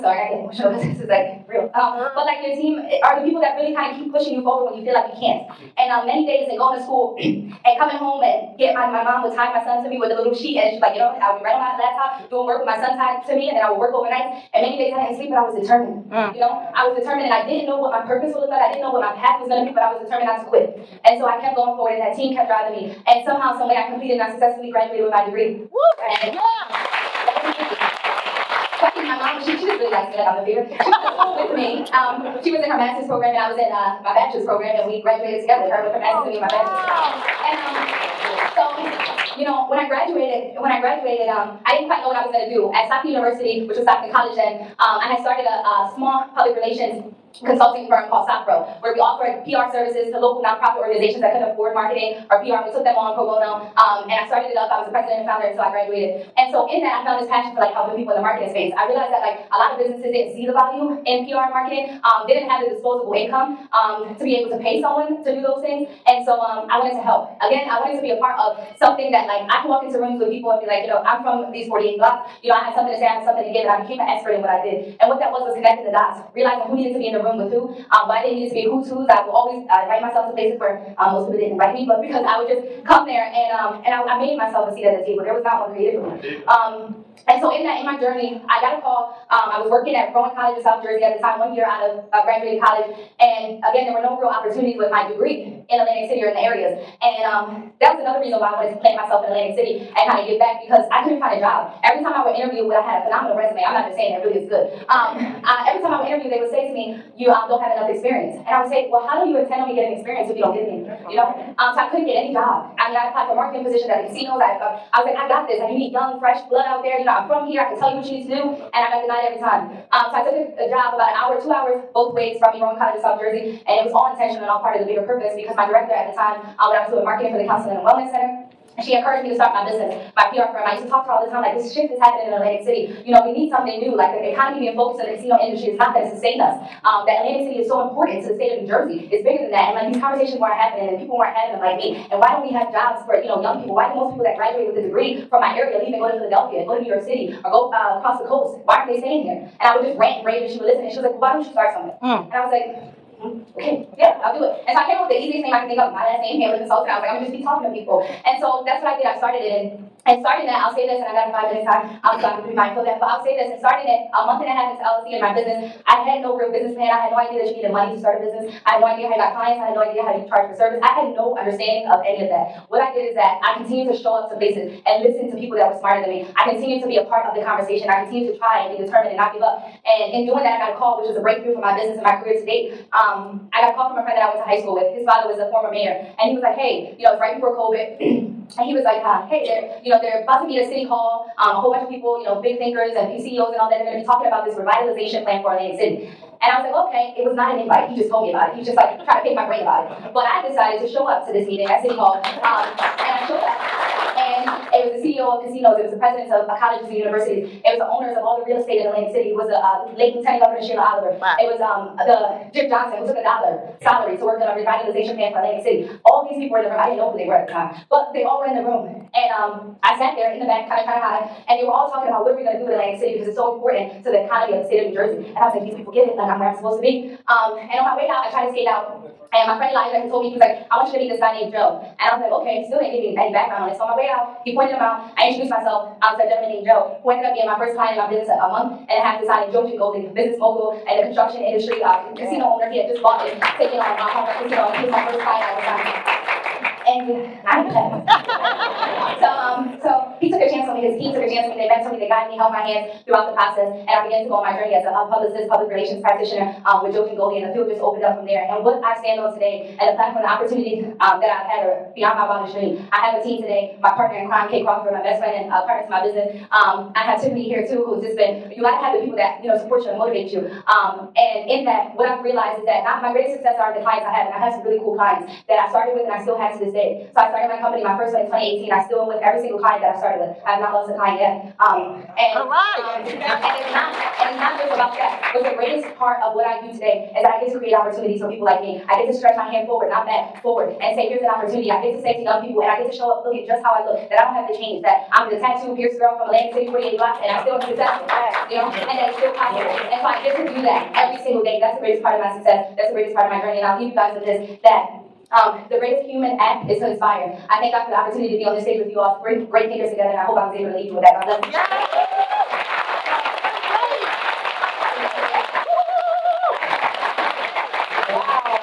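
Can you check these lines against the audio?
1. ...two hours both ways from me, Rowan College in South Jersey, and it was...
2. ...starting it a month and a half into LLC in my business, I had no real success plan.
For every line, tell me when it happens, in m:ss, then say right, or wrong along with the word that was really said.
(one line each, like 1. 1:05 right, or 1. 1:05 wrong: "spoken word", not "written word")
1. 2:01 right
2. 2:43 wrong: "business", not "success".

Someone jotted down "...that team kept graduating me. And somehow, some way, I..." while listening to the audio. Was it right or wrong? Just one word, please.
wrong.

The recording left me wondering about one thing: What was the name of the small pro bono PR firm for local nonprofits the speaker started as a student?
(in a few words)
SAPRO.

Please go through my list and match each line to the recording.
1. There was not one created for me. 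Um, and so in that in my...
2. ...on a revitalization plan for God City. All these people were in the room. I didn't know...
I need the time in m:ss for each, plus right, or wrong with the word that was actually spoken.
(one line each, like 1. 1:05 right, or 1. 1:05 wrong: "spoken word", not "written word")
1. 1:25 right
2. 3:34 wrong: "Atlantic", not "God".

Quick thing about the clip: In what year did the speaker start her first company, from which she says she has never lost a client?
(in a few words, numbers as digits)
2018.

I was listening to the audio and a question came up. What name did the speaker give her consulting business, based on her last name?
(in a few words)
Hamlett Consultant.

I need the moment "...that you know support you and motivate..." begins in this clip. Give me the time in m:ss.
4:29.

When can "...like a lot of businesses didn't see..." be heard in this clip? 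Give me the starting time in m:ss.
0:59.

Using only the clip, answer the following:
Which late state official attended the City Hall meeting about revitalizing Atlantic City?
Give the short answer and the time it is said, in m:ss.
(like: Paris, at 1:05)
Sheila Oliver, at 3:30.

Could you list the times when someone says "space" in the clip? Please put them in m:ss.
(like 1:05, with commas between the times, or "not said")
0:58.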